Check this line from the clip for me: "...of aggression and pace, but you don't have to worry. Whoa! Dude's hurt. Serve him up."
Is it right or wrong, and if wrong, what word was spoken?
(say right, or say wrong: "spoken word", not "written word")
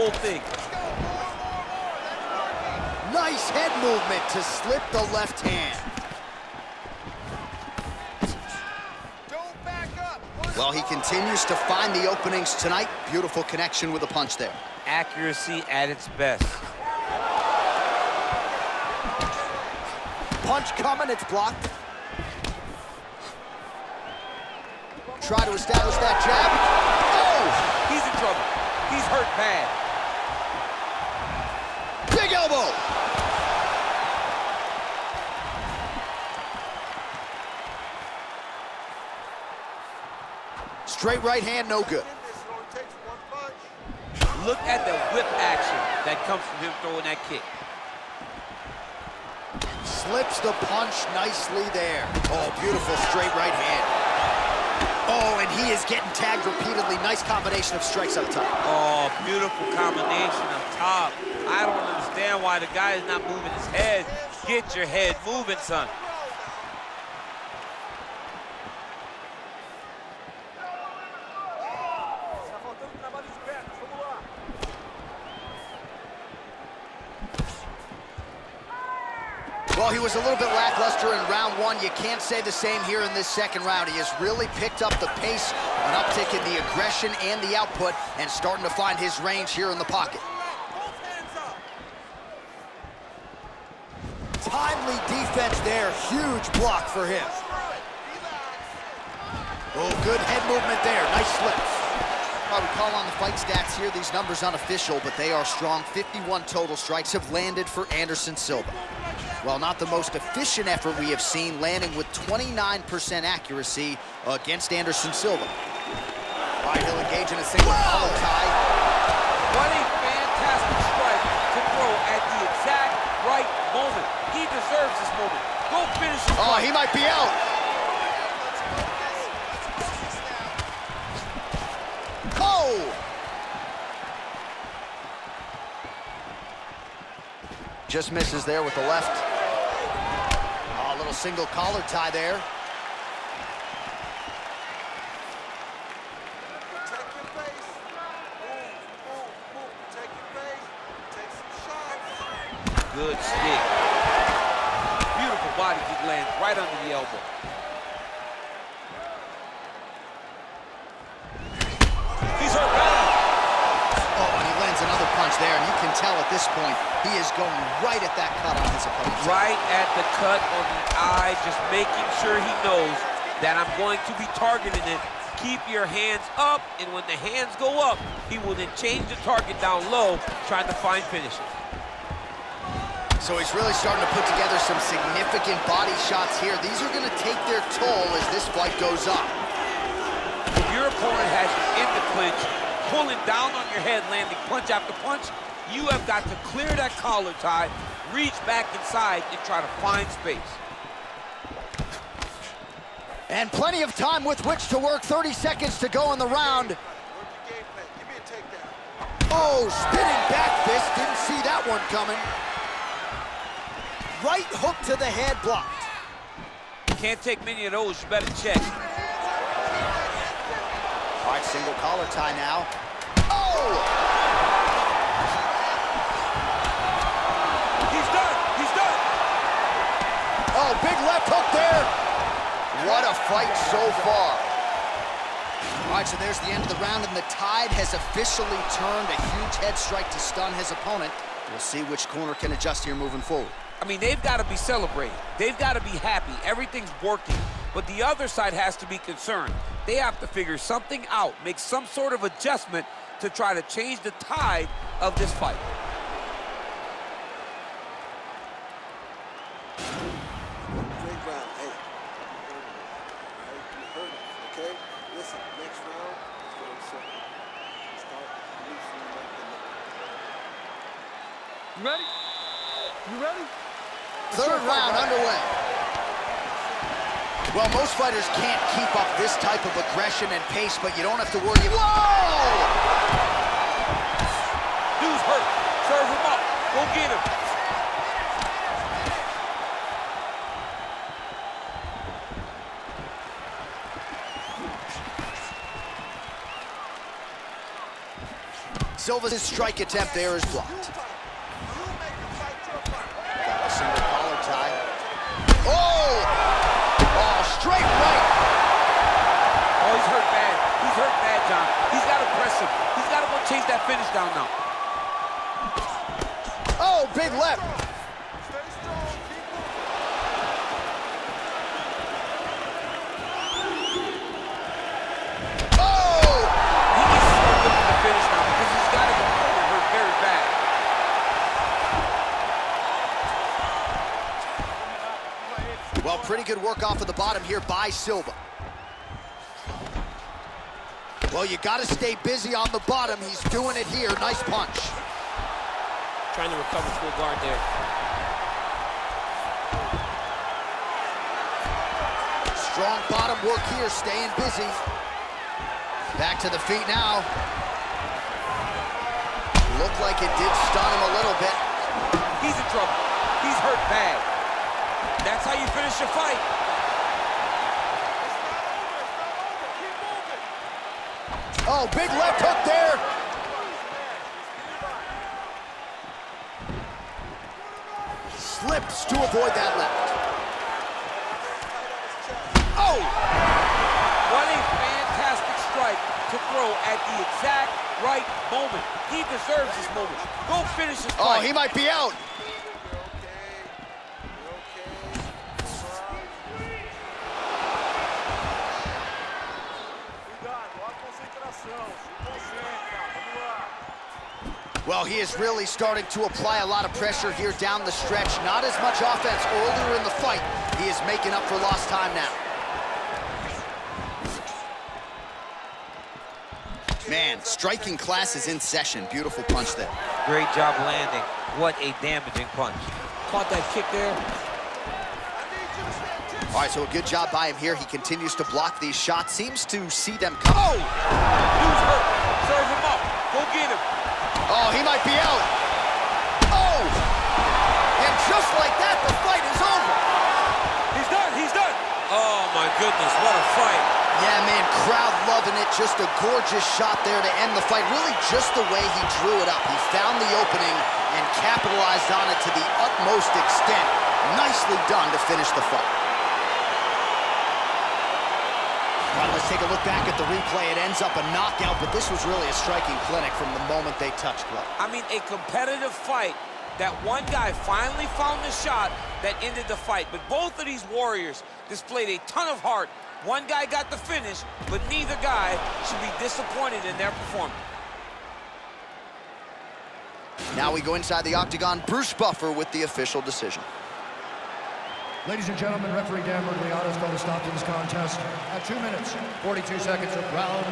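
right.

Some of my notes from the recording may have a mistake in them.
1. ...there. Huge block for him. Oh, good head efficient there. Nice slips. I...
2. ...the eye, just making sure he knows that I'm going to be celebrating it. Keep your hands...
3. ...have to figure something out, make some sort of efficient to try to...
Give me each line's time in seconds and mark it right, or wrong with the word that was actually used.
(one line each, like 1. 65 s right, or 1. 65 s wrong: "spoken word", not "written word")
1. 95 s wrong: "movement", not "efficient"
2. 170 s wrong: "targeting", not "celebrating"
3. 249 s wrong: "adjustment", not "efficient".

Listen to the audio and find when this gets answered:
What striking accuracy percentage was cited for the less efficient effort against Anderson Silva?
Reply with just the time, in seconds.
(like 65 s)
112 s.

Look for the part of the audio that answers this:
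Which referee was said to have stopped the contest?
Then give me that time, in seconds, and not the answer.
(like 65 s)
486 s.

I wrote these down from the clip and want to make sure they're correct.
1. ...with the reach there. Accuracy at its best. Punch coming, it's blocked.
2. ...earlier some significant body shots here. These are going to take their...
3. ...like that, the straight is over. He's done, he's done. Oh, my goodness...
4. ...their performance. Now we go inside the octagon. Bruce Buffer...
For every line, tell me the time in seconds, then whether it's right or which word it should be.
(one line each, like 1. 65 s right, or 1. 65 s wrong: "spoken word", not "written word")
1. 13 s wrong: "punch", not "reach"
2. 184 s wrong: "together", not "earlier"
3. 438 s wrong: "fight", not "straight"
4. 476 s right.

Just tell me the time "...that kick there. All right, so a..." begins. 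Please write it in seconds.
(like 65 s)
423 s.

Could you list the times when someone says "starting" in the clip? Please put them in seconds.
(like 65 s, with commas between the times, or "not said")
88 s, 183 s, 405 s.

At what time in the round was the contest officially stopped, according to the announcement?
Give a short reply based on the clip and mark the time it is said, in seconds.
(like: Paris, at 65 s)
2:42, at 488 s.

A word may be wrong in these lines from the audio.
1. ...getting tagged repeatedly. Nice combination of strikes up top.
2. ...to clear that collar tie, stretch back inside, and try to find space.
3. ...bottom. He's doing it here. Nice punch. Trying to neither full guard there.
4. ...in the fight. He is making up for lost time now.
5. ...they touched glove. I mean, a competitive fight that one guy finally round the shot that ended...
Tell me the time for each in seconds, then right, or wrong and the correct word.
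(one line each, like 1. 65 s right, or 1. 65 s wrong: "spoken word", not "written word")
1. 55 s right
2. 196 s wrong: "reach", not "stretch"
3. 342 s wrong: "recover", not "neither"
4. 409 s right
5. 463 s wrong: "found", not "round".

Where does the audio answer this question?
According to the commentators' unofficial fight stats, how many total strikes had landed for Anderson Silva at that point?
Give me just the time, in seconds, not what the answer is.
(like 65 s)
105 s.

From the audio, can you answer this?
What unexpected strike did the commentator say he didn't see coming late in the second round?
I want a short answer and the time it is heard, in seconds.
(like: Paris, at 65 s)
Spinning back fist, at 209 s.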